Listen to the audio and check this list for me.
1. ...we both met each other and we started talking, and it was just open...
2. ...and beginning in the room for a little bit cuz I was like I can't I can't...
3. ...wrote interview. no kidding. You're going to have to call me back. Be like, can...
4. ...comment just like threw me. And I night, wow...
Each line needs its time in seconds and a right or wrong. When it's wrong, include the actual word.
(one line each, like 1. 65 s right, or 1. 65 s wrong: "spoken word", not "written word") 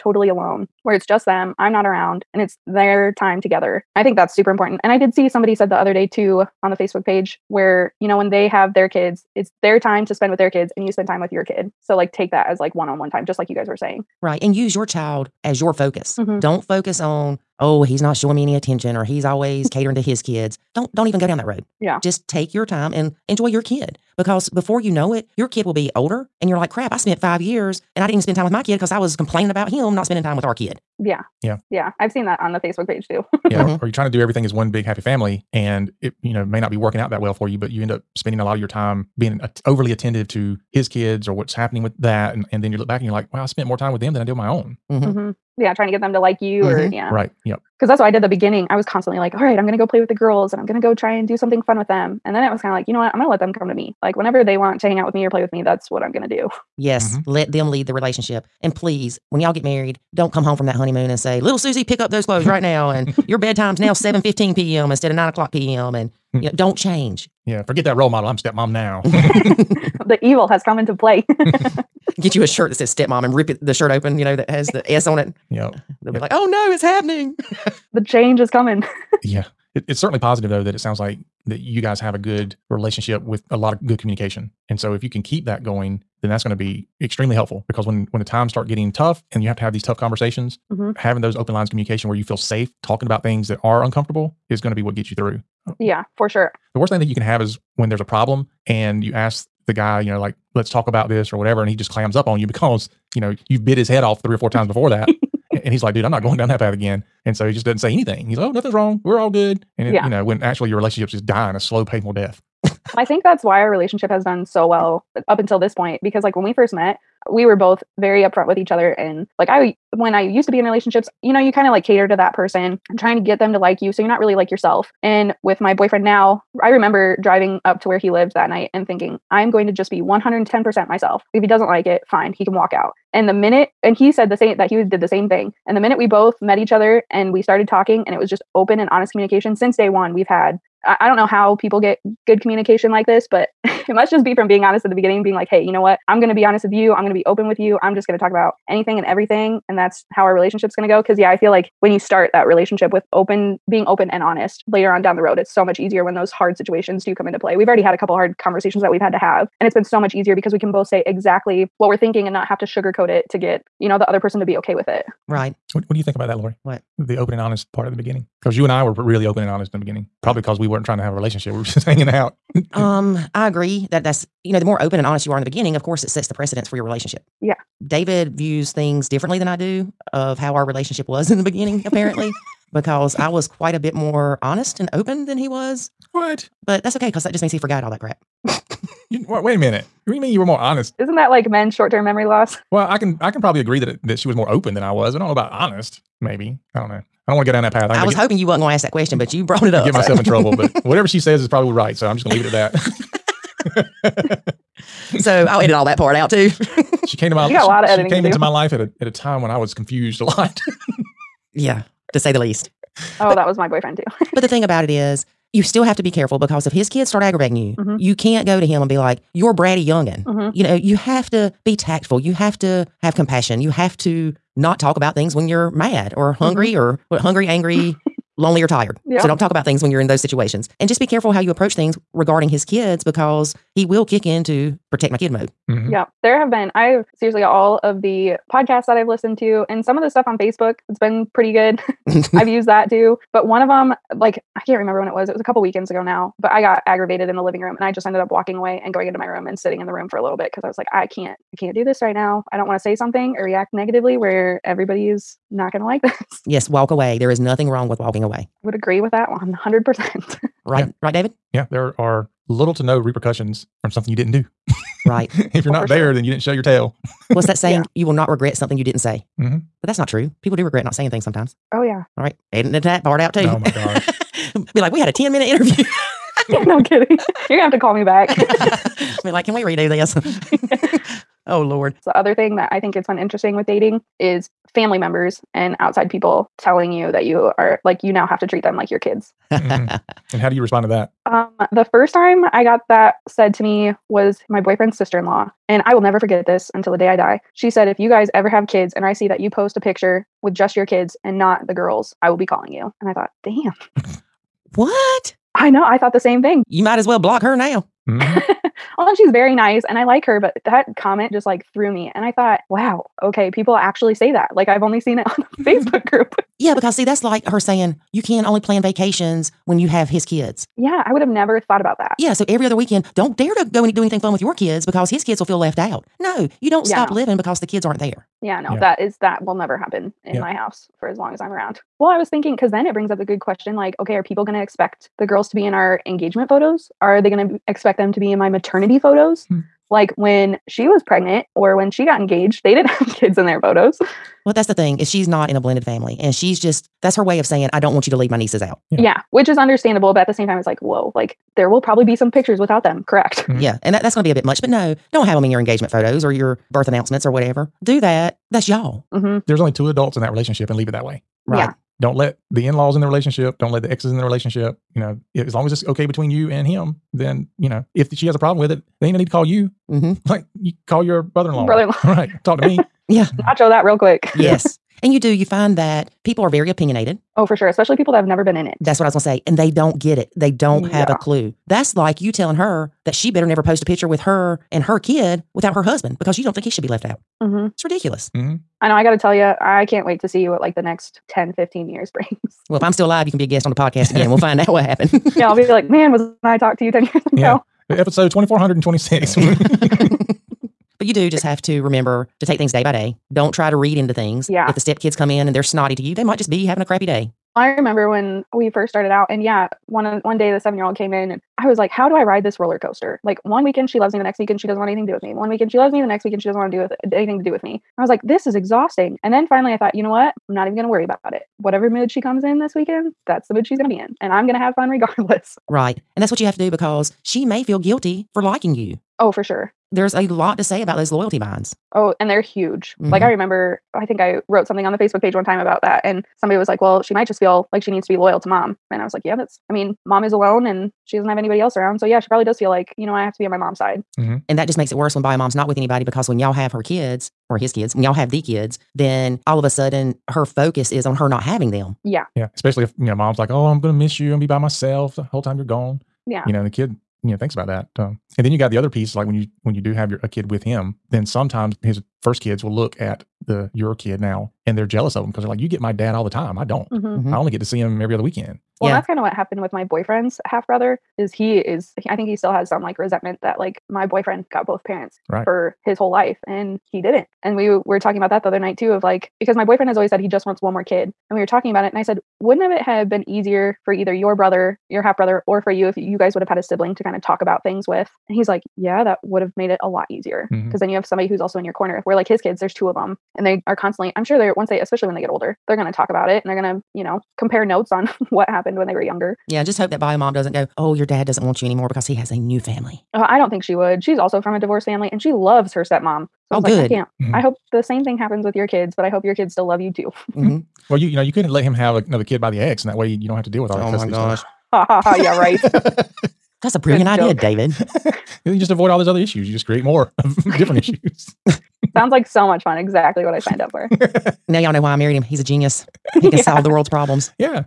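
1. 135 s right
2. 249 s wrong: "sitting", not "beginning"
3. 275 s wrong: "minute", not "wrote"
4. 310 s wrong: "thought", not "night".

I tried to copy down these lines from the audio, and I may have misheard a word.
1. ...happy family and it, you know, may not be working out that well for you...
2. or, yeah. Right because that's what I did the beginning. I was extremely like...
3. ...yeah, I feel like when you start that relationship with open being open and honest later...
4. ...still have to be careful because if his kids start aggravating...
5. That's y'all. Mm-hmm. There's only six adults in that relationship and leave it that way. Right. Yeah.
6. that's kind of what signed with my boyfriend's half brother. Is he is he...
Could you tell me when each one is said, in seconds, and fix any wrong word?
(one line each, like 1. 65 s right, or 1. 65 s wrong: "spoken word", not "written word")
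1. 34 s right
2. 46 s wrong: "constantly", not "extremely"
3. 151 s right
4. 215 s right
5. 358 s wrong: "two", not "six"
6. 468 s wrong: "happened", not "signed".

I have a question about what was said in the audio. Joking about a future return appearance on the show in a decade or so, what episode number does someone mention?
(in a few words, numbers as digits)
2426.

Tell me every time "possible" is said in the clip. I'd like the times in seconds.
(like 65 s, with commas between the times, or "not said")
not said.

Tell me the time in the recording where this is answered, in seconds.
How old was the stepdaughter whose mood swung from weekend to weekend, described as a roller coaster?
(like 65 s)
410 s.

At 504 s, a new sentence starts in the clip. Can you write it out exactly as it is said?
She's also from a divorced family, and she loves her stepmom.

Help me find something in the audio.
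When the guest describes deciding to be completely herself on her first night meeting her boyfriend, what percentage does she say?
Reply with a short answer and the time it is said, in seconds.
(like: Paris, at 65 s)
110%, at 130 s.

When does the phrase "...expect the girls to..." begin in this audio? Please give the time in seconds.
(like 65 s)
334 s.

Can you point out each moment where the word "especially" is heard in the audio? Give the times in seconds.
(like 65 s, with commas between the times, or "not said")
377 s, 452 s, 494 s.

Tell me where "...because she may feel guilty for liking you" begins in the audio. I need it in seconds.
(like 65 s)
426 s.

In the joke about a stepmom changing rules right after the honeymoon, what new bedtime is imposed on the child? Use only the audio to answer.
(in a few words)
7:15 p.m.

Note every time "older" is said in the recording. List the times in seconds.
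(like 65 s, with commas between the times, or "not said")
25 s, 495 s.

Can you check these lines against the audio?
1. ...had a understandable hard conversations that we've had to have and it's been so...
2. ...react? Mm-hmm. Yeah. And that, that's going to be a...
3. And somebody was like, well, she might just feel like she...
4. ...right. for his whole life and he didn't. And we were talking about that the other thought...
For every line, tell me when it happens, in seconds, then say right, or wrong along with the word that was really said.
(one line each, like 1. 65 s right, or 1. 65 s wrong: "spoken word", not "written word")
1. 157 s wrong: "couple", not "understandable"
2. 353 s wrong: "correct", not "react"
3. 436 s right
4. 475 s wrong: "night", not "thought".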